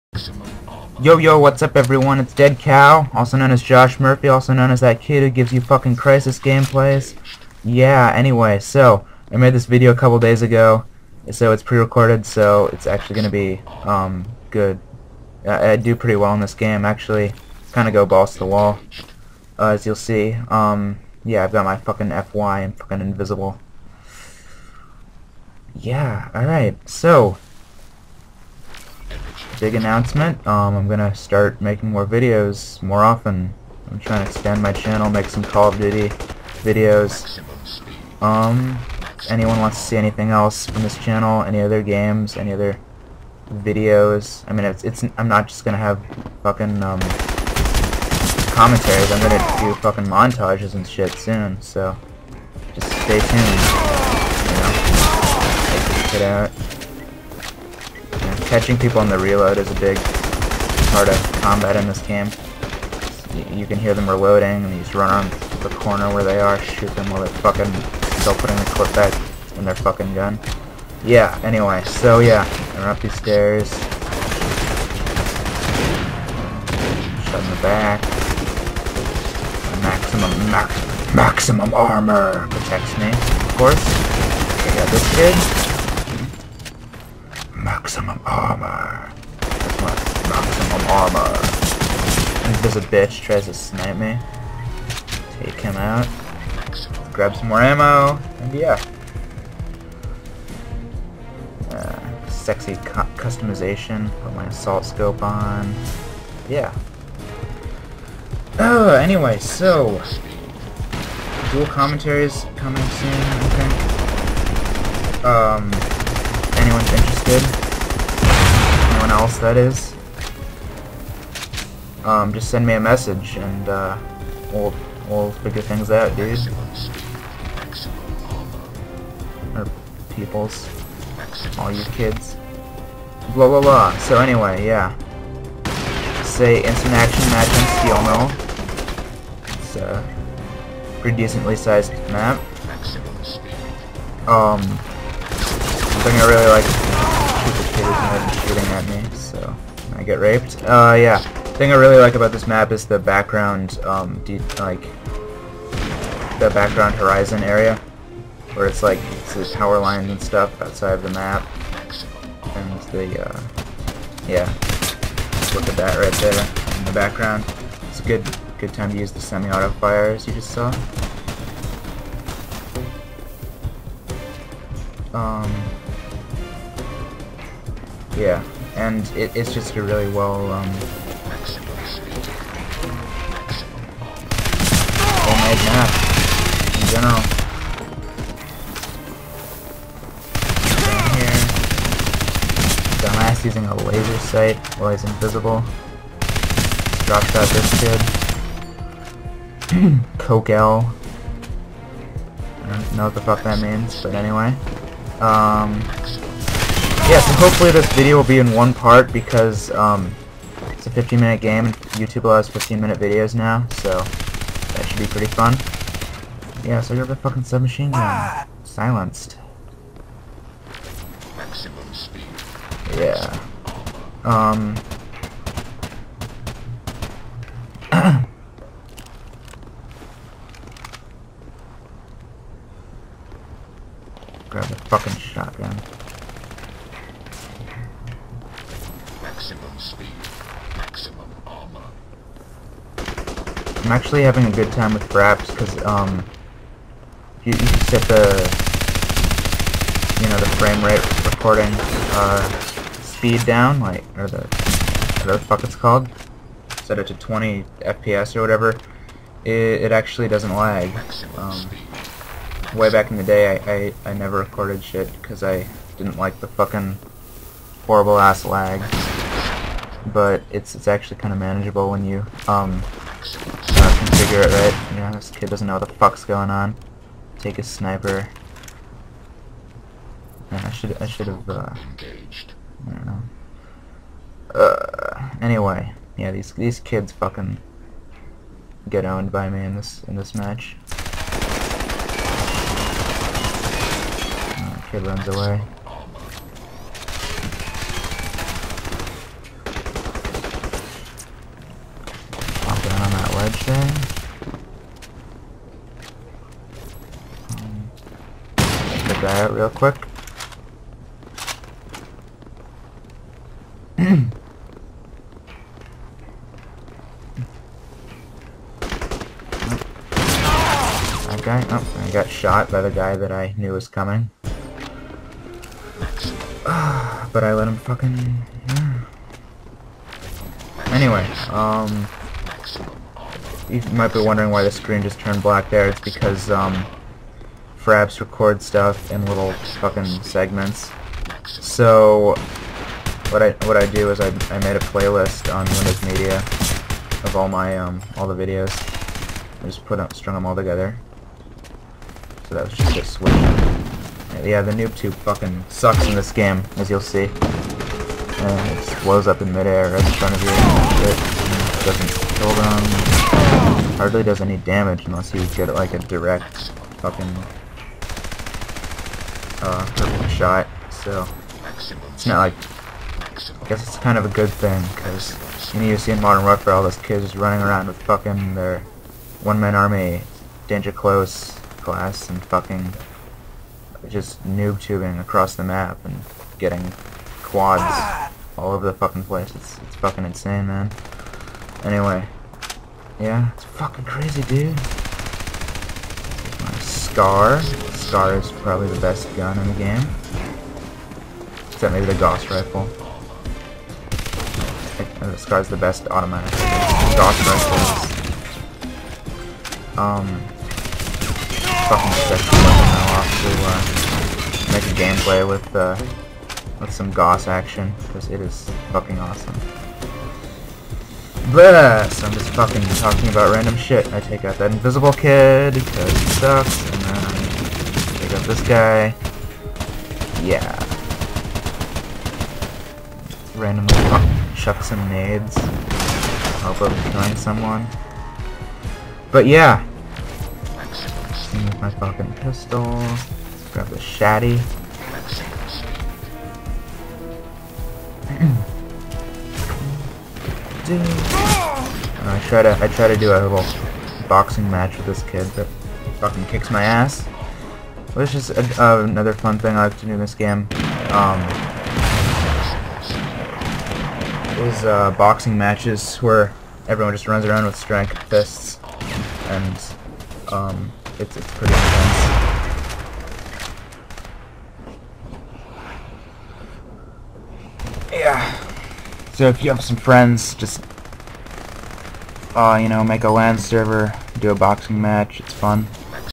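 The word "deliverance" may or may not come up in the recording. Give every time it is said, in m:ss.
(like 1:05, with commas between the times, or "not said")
not said.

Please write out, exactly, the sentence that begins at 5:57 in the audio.
And it just blows up in midair right in front of you.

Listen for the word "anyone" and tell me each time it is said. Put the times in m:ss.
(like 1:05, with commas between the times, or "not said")
0:39, 1:56.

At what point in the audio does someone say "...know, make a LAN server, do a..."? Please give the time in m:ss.
8:02.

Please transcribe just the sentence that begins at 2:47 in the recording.
It's a good, good time to use the semi-auto fire, as you just saw.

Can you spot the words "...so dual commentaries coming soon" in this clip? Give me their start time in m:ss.
1:49.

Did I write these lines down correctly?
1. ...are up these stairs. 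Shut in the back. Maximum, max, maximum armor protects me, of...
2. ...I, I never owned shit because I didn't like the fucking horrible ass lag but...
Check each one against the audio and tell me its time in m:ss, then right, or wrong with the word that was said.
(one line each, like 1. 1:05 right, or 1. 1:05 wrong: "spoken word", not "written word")
1. 1:12 right
2. 4:24 wrong: "recorded", not "owned".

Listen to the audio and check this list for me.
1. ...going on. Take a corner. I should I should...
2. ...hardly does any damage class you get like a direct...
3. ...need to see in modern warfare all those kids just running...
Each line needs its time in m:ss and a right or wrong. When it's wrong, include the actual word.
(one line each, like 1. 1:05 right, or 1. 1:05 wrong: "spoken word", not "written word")
1. 4:36 wrong: "sniper", not "corner"
2. 6:03 wrong: "unless", not "class"
3. 6:15 right.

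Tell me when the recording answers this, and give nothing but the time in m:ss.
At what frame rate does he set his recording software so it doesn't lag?
4:17.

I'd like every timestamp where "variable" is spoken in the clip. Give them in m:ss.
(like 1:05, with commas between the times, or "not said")
not said.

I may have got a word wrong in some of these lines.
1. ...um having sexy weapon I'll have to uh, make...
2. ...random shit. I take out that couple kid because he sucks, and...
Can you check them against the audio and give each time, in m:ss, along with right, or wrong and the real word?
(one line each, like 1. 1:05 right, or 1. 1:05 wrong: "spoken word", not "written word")
1. 6:49 wrong: "fucking", not "having"
2. 7:03 wrong: "invisible", not "couple".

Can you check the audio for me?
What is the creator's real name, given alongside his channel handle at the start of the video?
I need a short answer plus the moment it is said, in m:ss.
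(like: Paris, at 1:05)
Josh Murphy, at 0:03.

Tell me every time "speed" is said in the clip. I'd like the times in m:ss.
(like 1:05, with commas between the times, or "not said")
3:41, 3:59, 4:13.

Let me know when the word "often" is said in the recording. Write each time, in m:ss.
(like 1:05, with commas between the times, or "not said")
0:33.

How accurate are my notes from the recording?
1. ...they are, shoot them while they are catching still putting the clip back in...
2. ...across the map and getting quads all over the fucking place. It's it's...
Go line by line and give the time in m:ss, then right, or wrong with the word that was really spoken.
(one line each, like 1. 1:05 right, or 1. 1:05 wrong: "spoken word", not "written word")
1. 1:06 wrong: "fucking", not "catching"
2. 6:25 right.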